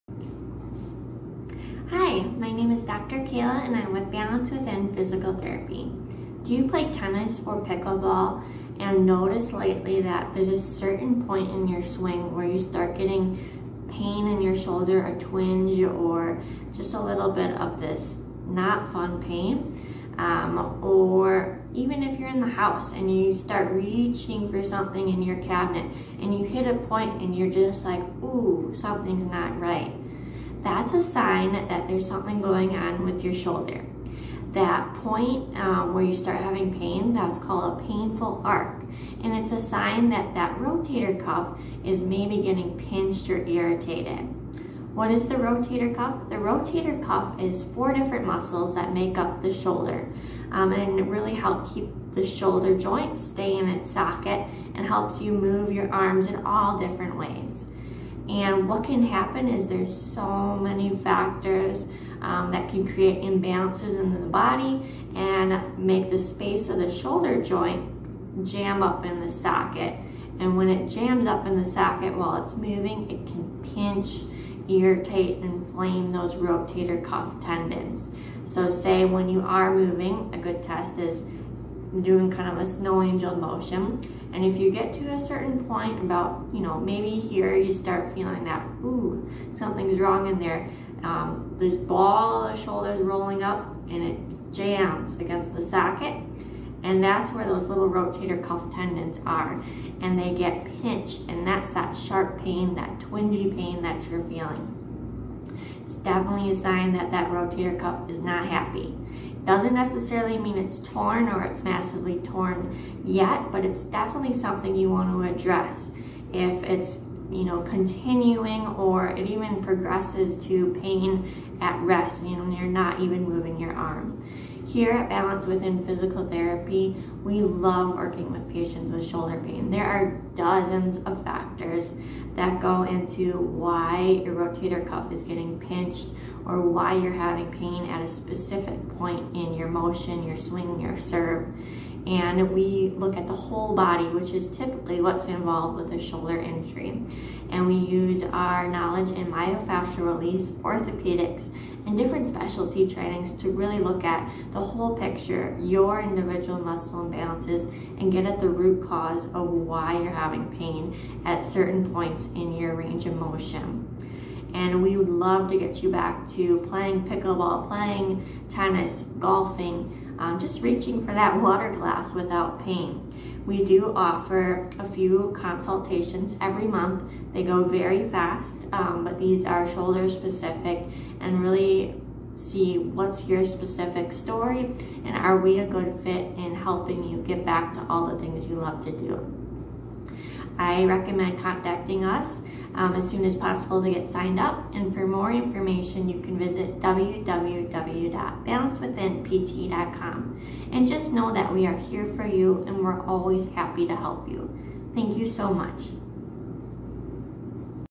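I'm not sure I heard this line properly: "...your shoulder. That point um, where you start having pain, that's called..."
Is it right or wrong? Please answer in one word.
right.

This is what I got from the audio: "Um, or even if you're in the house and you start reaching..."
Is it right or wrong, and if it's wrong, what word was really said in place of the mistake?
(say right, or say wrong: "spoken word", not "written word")
right.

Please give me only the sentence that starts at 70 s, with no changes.
And when it jams up in the socket while it's moving, it can pinch, irritate, and inflame those rotator cuff tendons.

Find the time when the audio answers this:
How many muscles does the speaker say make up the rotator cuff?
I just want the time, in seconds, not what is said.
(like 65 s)
47 s.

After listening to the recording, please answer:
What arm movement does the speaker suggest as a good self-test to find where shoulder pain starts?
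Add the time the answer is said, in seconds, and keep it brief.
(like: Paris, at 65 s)
snow angel, at 82 s.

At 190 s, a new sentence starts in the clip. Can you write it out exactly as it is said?
I recommend contacting us um, as soon as possible to get signed up.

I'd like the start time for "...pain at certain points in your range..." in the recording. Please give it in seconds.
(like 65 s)
160 s.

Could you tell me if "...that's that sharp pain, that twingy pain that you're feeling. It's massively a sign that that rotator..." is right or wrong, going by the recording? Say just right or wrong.
wrong.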